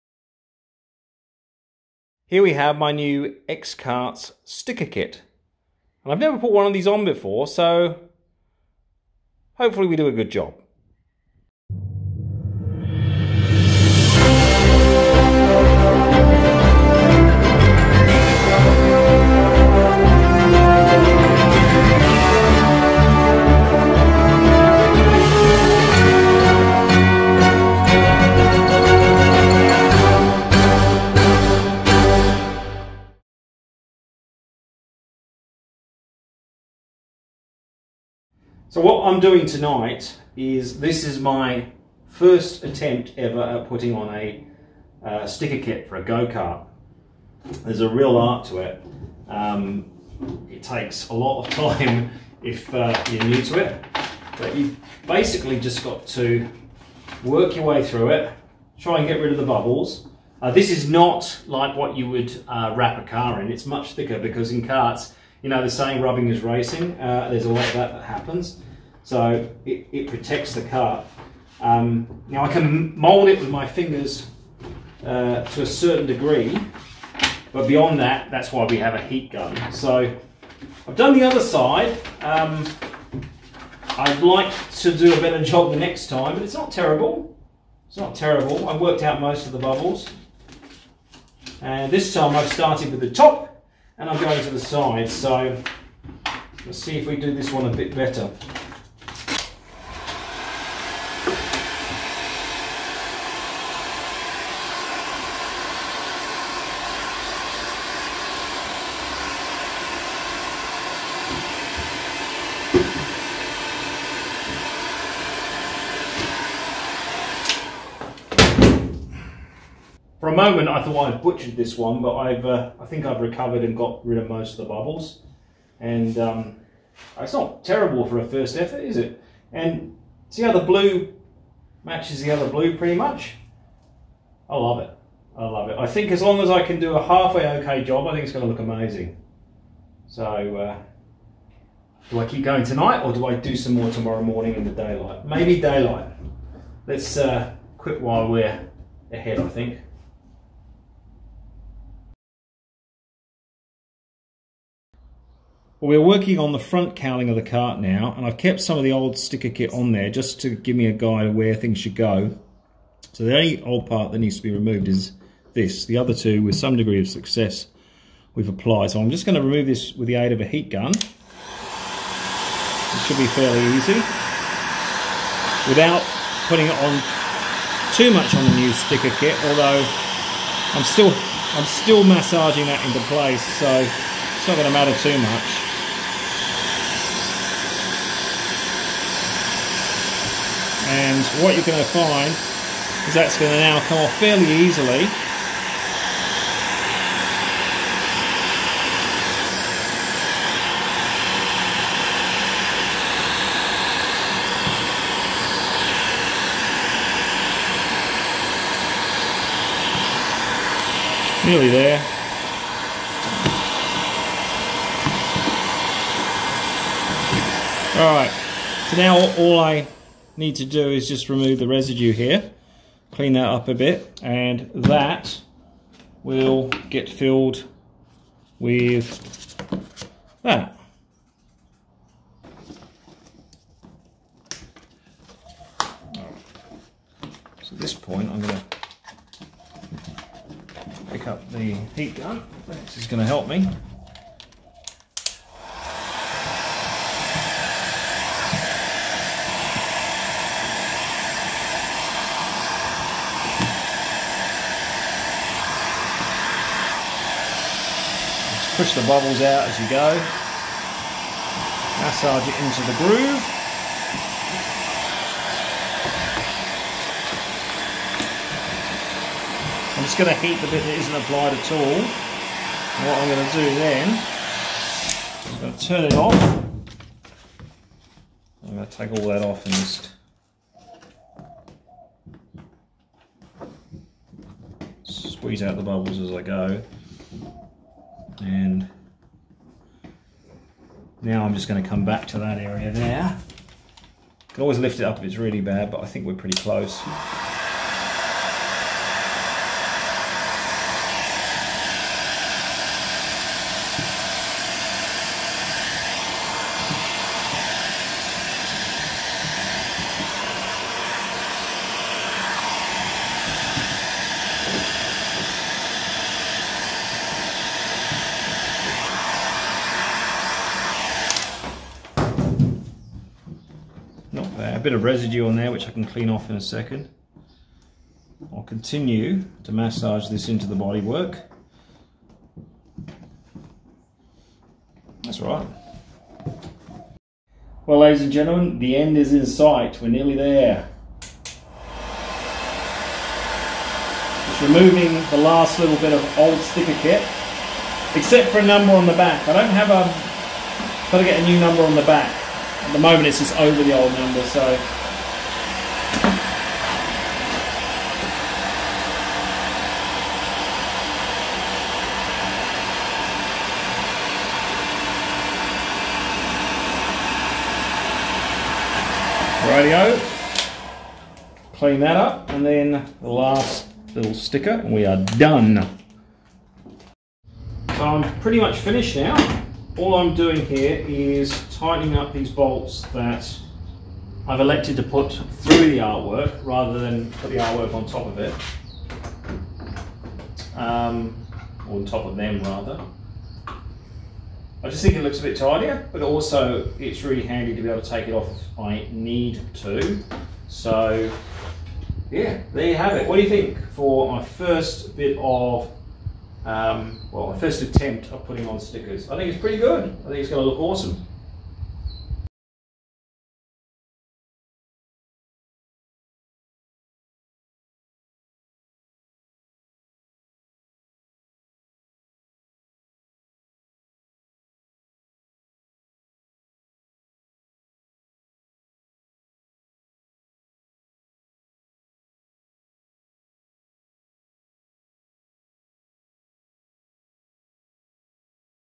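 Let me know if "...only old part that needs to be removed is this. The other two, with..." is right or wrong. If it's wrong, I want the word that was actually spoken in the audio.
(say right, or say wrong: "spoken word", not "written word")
right.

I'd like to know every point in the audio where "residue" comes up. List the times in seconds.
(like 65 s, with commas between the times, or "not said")
221 s, 325 s.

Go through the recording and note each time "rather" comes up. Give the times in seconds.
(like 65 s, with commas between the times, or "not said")
386 s, 392 s.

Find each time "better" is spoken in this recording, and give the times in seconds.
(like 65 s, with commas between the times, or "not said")
85 s, 97 s.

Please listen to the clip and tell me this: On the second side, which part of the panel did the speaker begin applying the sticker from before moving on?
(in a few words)
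the top.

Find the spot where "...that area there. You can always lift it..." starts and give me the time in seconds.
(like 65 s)
292 s.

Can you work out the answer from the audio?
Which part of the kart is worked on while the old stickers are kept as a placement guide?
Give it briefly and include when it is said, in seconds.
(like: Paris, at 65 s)
front cowling, at 156 s.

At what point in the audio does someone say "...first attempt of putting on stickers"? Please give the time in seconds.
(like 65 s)
407 s.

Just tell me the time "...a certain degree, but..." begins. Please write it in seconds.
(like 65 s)
75 s.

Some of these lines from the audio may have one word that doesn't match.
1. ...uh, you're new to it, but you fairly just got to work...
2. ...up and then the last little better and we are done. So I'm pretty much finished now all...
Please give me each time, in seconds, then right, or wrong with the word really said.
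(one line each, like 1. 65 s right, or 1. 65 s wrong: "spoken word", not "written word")
1. 52 s wrong: "basically", not "fairly"
2. 372 s wrong: "sticker", not "better".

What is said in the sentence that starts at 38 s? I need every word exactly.
So what I'm doing tonight is this is my first attempt ever at putting on a uh, sticker kit for a go-kart.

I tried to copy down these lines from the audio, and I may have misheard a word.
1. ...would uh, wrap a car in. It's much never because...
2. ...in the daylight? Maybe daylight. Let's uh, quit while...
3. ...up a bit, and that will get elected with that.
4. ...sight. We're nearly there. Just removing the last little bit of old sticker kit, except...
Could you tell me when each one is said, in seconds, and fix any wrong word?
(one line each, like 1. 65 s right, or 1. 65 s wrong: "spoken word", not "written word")
1. 62 s wrong: "thicker", not "never"
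2. 144 s right
3. 223 s wrong: "filled", not "elected"
4. 339 s right.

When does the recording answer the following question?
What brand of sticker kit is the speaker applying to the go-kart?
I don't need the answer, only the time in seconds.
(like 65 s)
3 s.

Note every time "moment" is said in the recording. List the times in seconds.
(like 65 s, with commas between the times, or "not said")
120 s, 352 s.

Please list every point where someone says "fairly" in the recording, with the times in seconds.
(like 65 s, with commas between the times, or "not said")
173 s, 194 s.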